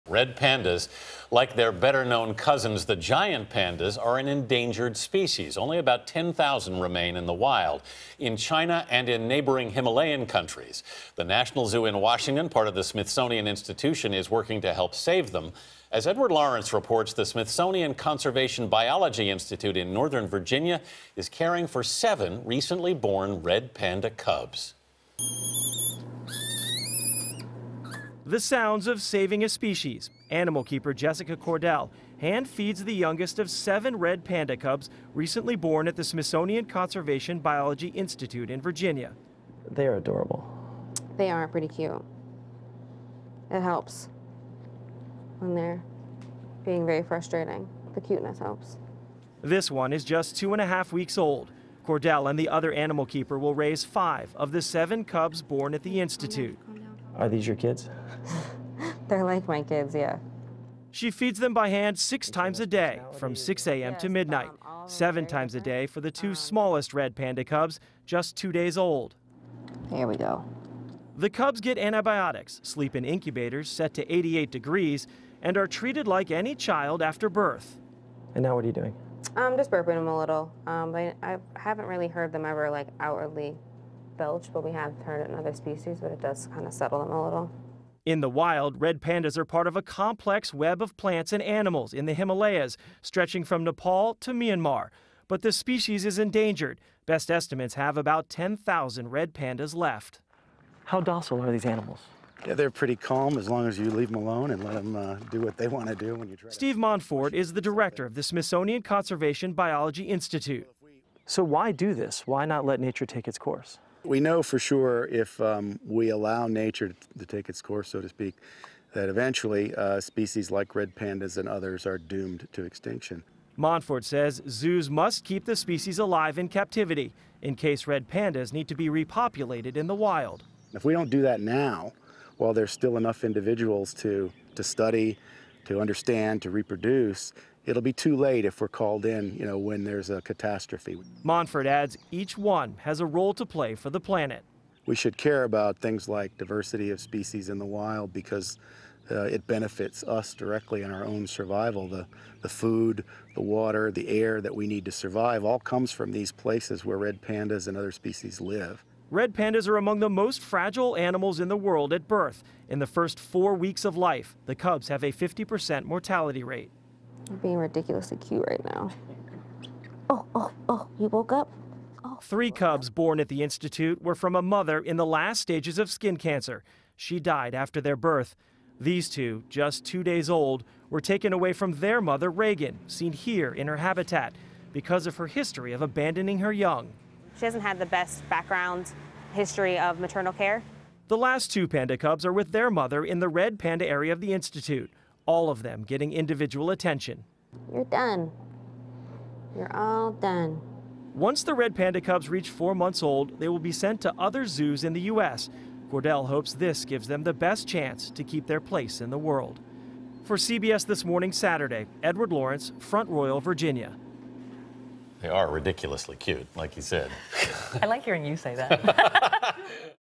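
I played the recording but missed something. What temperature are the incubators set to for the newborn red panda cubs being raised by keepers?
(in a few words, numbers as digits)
88 degrees.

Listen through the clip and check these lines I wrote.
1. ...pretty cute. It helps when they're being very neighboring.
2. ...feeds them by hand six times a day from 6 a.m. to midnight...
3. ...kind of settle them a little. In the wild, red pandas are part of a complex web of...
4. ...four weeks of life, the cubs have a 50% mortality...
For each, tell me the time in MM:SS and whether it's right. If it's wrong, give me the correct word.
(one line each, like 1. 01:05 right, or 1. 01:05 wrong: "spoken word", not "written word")
1. 00:41 wrong: "frustrating", not "neighboring"
2. 01:01 right
3. 01:26 right
4. 02:43 right.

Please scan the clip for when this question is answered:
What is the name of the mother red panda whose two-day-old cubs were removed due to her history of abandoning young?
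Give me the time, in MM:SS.
03:02.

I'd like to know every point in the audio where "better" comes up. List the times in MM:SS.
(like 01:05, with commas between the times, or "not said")
00:01.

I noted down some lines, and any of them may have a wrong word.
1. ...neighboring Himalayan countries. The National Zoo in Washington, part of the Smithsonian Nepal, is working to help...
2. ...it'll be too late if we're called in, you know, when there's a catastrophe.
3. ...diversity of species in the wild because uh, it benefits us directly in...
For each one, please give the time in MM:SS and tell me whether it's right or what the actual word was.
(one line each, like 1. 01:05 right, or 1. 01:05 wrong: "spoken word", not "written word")
1. 00:09 wrong: "Institution", not "Nepal"
2. 02:17 right
3. 02:26 right.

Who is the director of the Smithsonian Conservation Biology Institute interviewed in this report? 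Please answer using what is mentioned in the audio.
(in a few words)
Steve Monfort.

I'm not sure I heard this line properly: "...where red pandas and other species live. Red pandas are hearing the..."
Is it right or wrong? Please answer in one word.
wrong.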